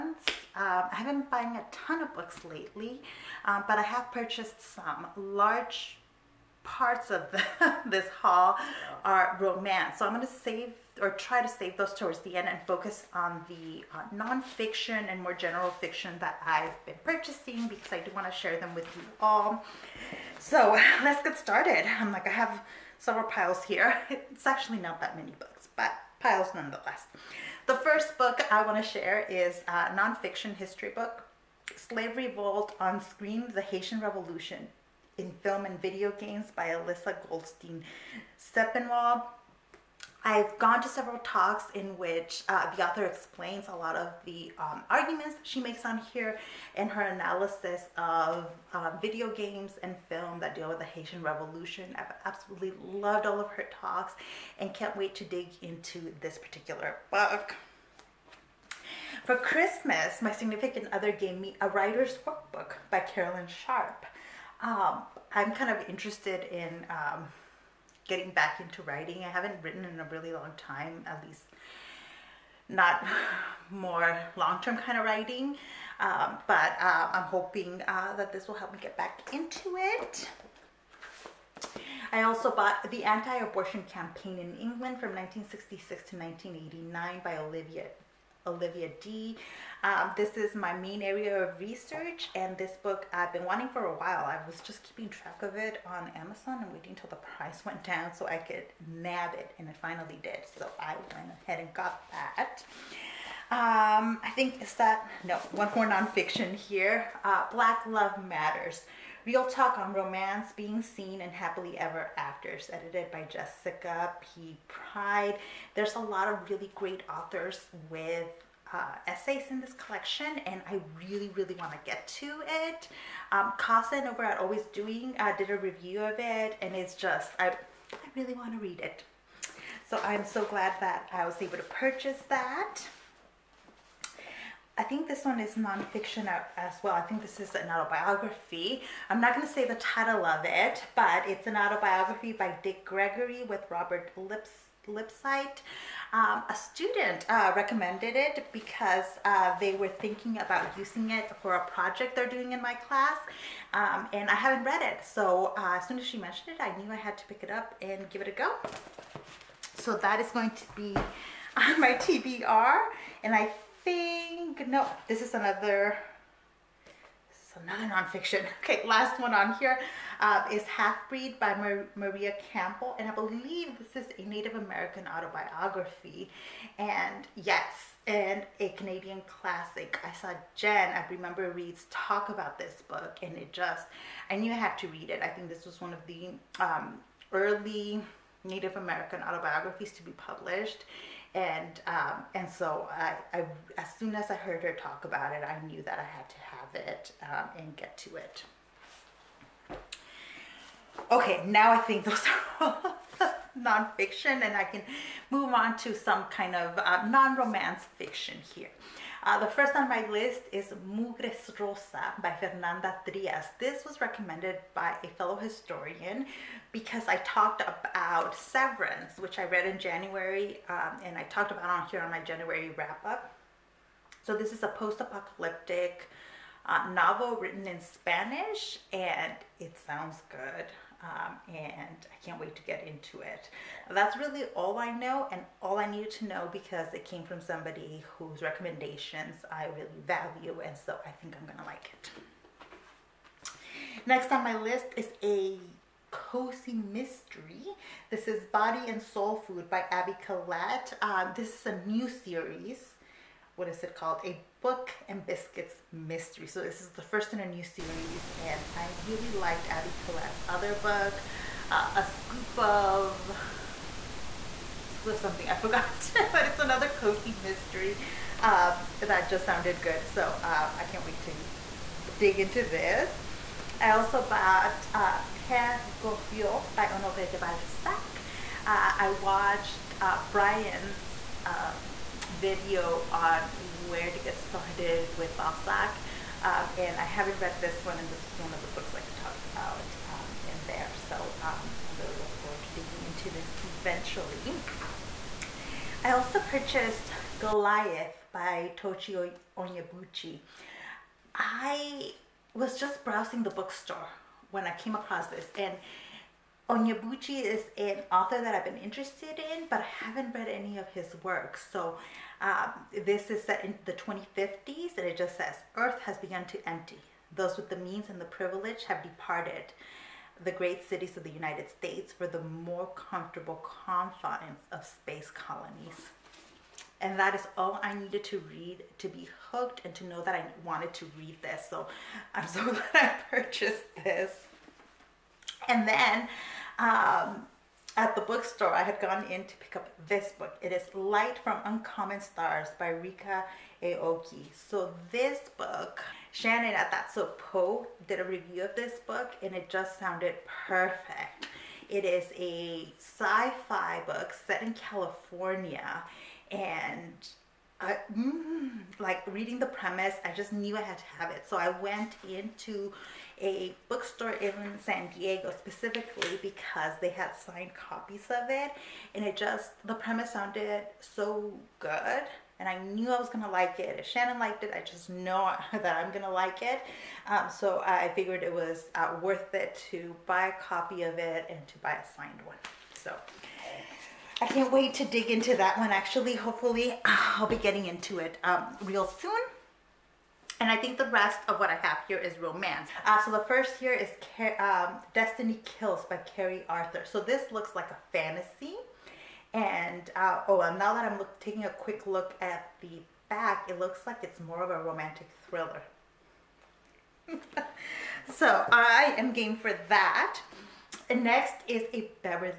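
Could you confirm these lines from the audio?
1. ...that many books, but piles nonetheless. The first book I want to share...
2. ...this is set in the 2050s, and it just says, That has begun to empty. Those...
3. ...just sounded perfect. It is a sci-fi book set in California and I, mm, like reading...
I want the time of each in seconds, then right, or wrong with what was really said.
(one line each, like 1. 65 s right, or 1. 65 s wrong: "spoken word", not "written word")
1. 25 s right
2. 313 s wrong: "Earth", not "That"
3. 349 s right.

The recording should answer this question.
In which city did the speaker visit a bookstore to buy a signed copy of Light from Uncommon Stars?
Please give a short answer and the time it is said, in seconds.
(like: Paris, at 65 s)
San Diego, at 364 s.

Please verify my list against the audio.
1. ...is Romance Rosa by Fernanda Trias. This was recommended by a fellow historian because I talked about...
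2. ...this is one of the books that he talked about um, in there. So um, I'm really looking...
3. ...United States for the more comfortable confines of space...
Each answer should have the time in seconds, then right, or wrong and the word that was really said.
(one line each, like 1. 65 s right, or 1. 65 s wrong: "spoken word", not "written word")
1. 210 s wrong: "Mugres", not "Romance"
2. 288 s right
3. 321 s right.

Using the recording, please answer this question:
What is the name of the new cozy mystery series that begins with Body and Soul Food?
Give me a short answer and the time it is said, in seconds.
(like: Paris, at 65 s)
A Book and Biscuits Mystery, at 254 s.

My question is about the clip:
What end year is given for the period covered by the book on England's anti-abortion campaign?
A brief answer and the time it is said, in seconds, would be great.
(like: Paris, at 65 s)
1989, at 86 s.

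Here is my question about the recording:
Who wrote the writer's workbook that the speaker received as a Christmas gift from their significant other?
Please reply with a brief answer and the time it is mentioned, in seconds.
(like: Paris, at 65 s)
Caroline Sharp, at 62 s.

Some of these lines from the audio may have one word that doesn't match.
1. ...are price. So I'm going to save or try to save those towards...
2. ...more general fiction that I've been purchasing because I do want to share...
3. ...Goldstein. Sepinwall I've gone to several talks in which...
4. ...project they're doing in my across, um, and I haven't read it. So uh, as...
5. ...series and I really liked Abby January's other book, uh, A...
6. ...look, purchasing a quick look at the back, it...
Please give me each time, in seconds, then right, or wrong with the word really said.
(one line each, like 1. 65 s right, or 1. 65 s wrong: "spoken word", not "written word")
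1. 9 s wrong: "romance", not "price"
2. 15 s right
3. 37 s right
4. 151 s wrong: "class", not "across"
5. 257 s wrong: "Collette", not "January"
6. 401 s wrong: "taking", not "purchasing".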